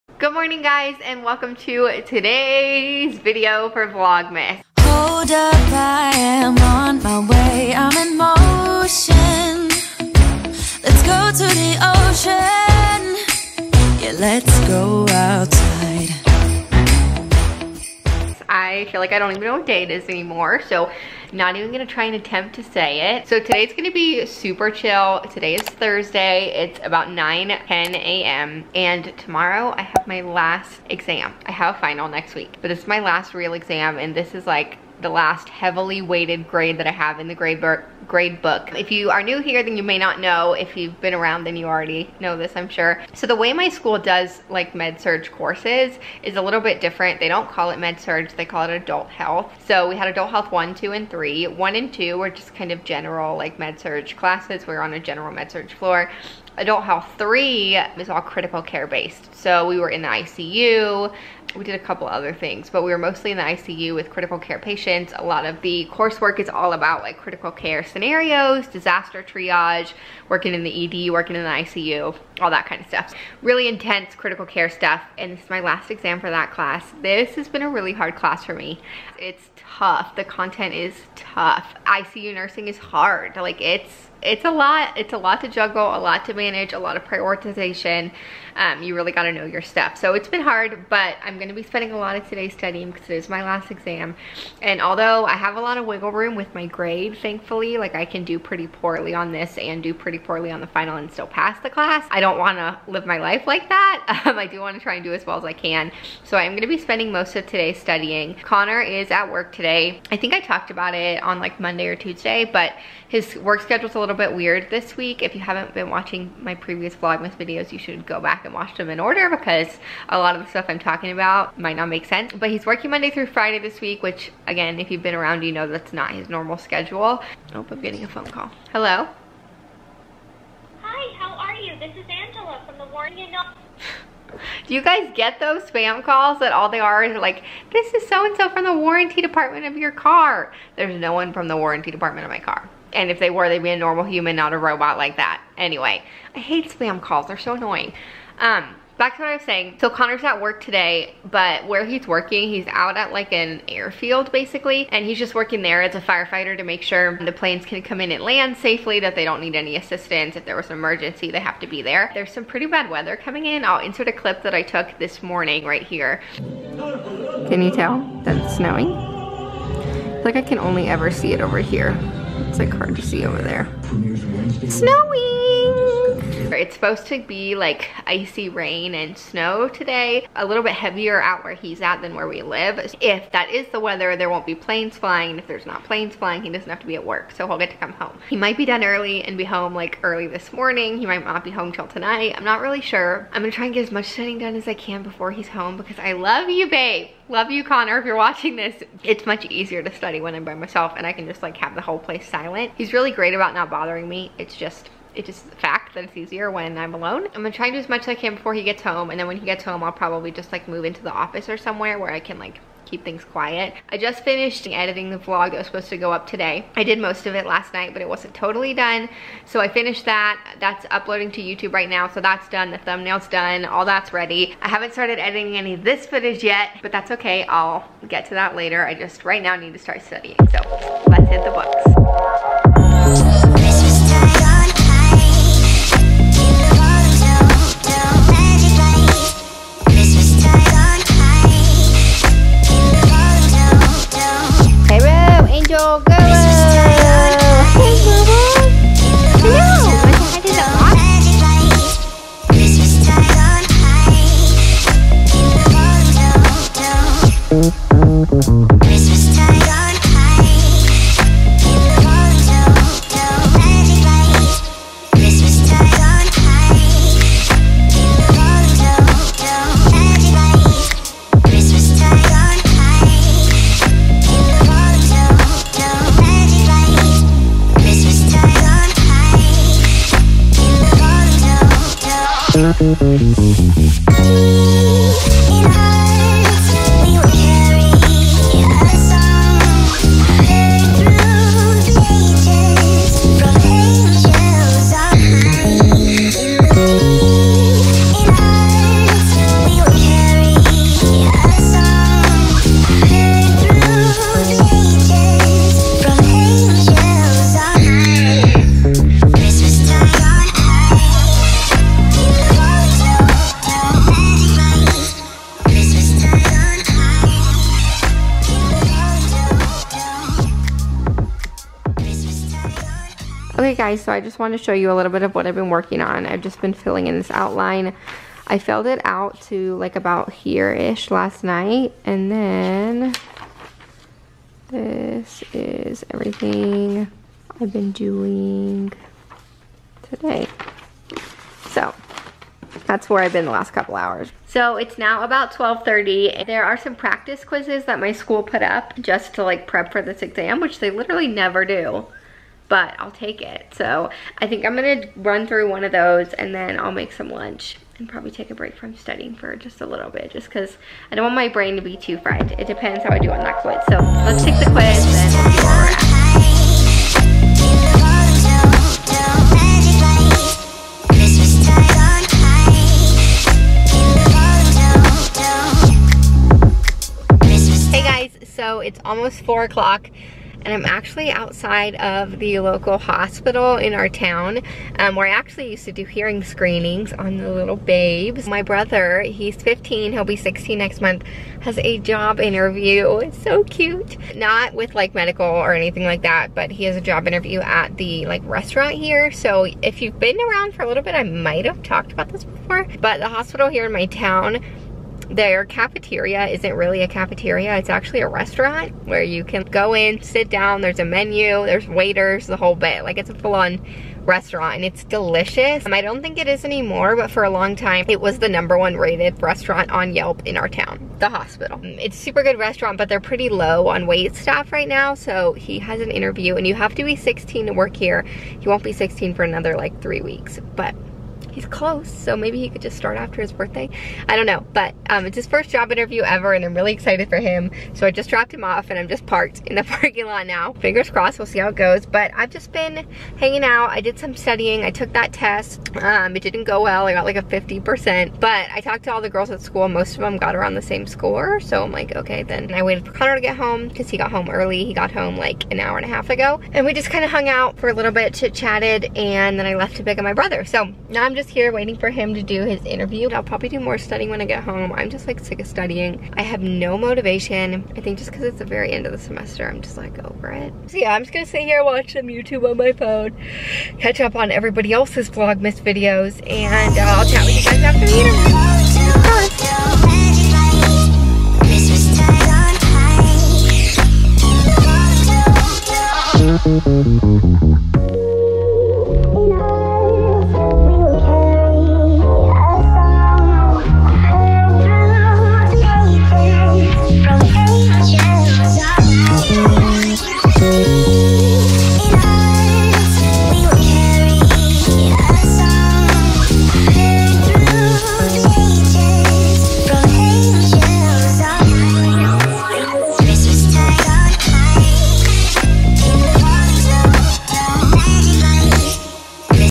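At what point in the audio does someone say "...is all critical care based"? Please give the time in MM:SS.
00:57.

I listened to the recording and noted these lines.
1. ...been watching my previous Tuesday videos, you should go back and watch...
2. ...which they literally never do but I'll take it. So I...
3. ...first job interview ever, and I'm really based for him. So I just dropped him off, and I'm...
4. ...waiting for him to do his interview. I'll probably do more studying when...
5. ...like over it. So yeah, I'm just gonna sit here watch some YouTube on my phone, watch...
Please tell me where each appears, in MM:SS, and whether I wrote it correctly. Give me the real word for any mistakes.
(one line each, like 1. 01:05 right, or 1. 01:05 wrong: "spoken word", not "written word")
1. 01:55 wrong: "Vlogmas", not "Tuesday"
2. 05:50 right
3. 07:15 wrong: "excited", not "based"
4. 07:41 right
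5. 07:49 wrong: "catch", not "watch".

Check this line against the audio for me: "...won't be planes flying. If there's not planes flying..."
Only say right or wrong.
right.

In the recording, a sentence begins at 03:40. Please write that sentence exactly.
That's uploading to YouTube right now, so that's done.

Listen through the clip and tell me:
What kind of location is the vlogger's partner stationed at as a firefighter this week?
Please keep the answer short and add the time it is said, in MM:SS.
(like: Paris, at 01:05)
An airfield, at 02:33.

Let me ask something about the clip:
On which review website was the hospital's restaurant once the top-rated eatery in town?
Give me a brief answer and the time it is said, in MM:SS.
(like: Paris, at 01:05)
Yelp, at 07:00.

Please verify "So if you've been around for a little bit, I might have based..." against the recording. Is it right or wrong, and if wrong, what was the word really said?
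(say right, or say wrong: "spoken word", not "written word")
wrong: "talked", not "based".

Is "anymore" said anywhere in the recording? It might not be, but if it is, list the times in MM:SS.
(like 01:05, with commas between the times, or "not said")
00:20, 06:56.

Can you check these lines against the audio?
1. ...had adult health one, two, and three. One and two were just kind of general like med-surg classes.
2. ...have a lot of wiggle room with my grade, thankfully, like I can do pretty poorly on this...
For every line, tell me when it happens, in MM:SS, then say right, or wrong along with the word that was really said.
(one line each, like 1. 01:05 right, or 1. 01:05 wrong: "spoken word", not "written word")
1. 00:49 right
2. 01:35 right.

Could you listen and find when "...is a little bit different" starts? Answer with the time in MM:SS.
00:46.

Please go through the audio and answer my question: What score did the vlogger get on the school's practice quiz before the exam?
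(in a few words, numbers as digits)
50%.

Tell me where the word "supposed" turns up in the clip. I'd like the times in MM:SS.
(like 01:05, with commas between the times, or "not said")
02:56, 03:35.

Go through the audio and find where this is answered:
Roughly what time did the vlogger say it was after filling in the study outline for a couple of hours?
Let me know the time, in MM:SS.
05:45.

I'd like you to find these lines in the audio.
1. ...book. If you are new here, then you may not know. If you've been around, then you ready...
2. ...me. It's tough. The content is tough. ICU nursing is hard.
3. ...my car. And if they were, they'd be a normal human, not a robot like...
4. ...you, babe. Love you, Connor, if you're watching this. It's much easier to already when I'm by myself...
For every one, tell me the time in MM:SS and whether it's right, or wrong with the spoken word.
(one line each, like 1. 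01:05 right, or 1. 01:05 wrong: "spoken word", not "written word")
1. 00:38 wrong: "already", not "ready"
2. 01:18 right
3. 02:22 right
4. 03:16 wrong: "study", not "already".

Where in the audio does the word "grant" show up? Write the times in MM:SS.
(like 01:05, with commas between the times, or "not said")
not said.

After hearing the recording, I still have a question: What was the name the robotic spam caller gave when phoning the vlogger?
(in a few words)
Angela.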